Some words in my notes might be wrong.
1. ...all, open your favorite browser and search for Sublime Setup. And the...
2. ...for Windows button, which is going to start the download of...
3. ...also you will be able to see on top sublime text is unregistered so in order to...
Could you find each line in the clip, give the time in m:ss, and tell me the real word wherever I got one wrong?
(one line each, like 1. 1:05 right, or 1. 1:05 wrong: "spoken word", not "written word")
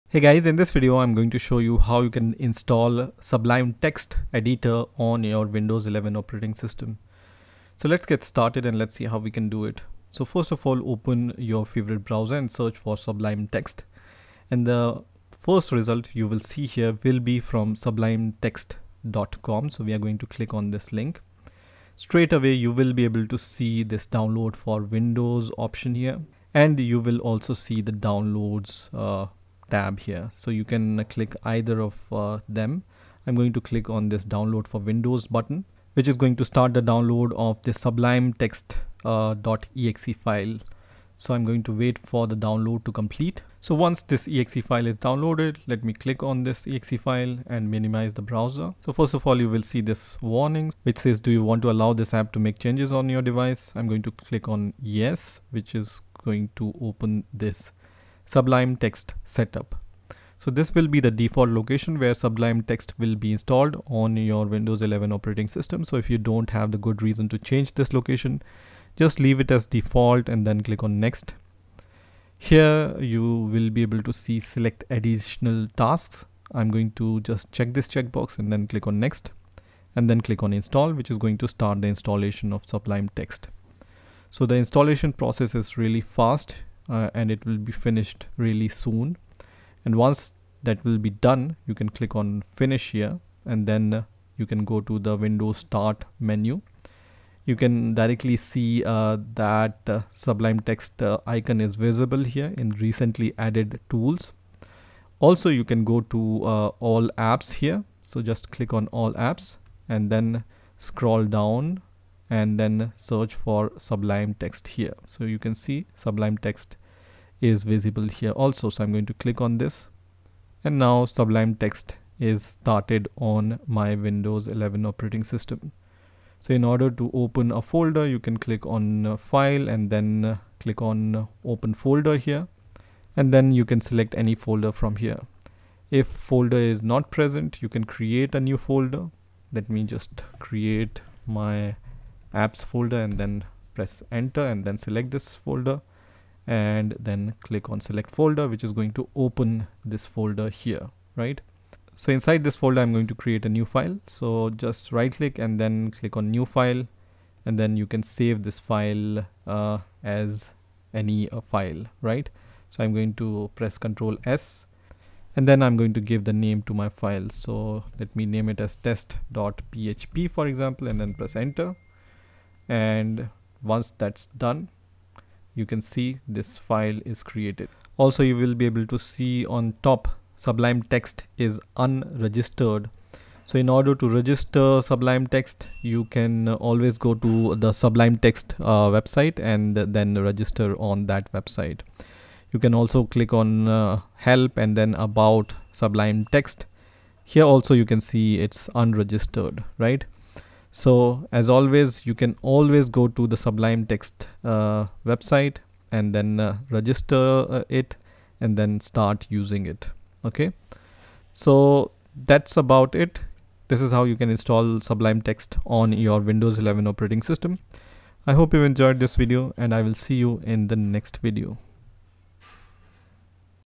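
1. 0:10 wrong: "Text", not "Setup"
2. 0:34 right
3. 2:57 right.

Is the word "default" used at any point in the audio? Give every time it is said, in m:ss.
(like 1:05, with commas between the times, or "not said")
1:01, 1:09.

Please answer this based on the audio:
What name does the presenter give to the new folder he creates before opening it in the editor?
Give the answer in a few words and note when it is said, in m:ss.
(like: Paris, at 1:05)
my apps, at 2:21.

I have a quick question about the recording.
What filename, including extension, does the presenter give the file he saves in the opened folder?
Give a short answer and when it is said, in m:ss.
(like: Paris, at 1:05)
test.php, at 2:48.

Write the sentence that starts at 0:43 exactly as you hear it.
So once this exe file is downloaded, let me click on this exe file and minimize the browser.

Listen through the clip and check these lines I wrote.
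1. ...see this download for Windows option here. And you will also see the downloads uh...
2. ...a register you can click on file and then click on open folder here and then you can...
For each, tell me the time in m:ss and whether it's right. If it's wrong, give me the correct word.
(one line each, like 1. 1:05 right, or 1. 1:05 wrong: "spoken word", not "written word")
1. 0:23 right
2. 2:07 wrong: "folder", not "register".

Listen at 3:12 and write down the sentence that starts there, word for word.
You can also click on uh, help and then about Sublime Text.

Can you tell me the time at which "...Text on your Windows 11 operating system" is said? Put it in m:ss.
3:35.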